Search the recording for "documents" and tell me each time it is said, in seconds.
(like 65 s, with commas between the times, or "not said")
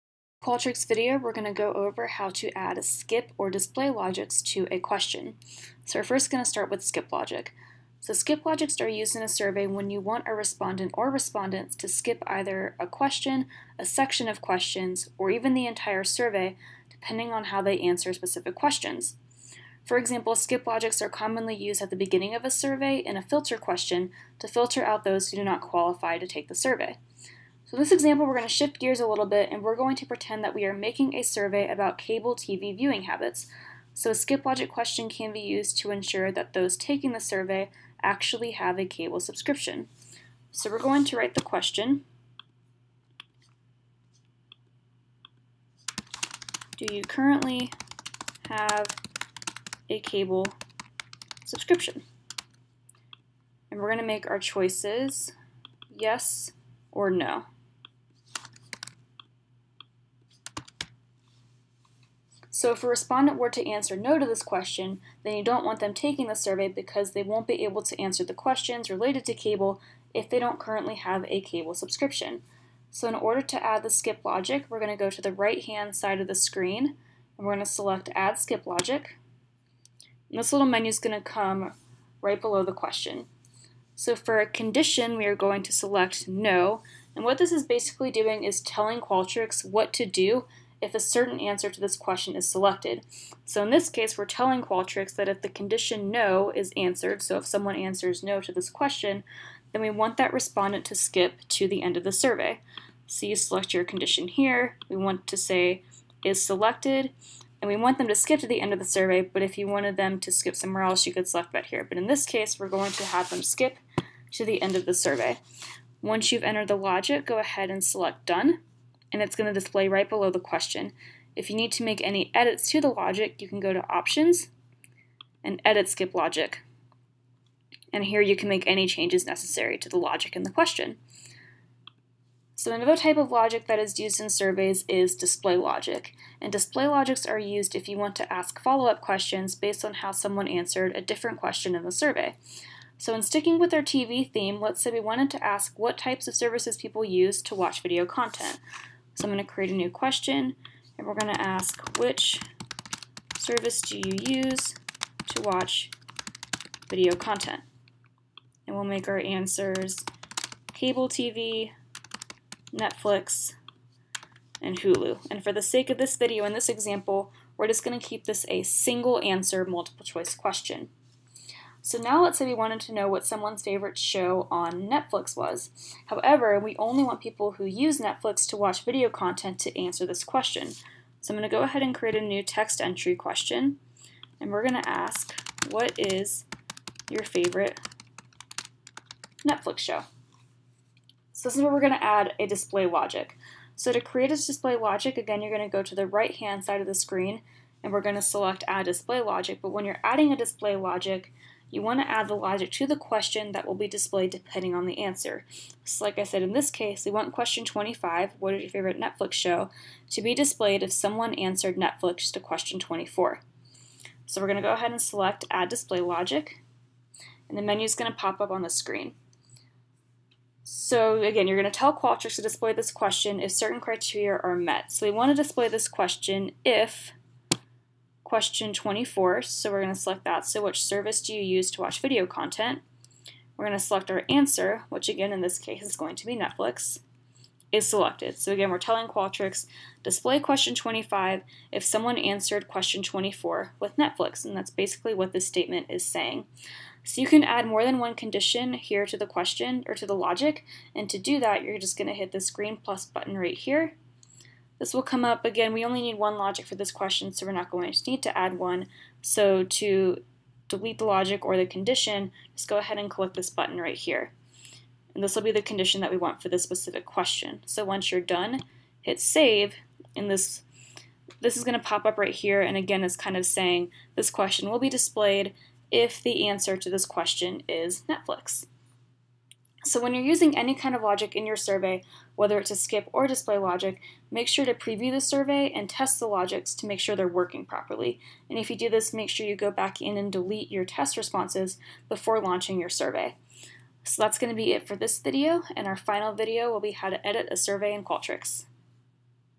not said.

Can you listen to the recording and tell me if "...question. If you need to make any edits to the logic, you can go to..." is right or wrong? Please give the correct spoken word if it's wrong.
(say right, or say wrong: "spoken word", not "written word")
right.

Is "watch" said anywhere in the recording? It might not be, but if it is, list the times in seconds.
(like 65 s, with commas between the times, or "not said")
147 s, 155 s, 178 s, 231 s.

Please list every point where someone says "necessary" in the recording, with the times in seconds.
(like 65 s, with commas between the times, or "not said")
129 s.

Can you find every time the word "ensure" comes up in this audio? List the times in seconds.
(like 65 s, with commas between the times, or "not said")
35 s.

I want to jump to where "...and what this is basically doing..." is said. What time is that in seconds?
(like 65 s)
87 s.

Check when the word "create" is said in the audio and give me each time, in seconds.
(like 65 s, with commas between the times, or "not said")
149 s, 181 s, 193 s.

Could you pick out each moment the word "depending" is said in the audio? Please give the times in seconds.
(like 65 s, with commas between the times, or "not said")
16 s, 204 s.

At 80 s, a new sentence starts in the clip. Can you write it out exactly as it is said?
And this little menu is going to come right below the question.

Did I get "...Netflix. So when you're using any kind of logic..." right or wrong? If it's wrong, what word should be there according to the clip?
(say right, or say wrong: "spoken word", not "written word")
right.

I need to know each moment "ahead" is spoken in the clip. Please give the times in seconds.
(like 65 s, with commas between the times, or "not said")
117 s, 181 s, 214 s, 262 s.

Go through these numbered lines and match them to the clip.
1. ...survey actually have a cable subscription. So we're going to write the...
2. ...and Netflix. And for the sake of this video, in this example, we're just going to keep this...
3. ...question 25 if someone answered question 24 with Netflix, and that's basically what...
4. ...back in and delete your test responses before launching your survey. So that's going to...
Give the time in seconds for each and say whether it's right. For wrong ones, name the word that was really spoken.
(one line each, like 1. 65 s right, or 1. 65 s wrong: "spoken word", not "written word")
1. 37 s right
2. 164 s wrong: "Hulu", not "Netflix"
3. 240 s right
4. 289 s right.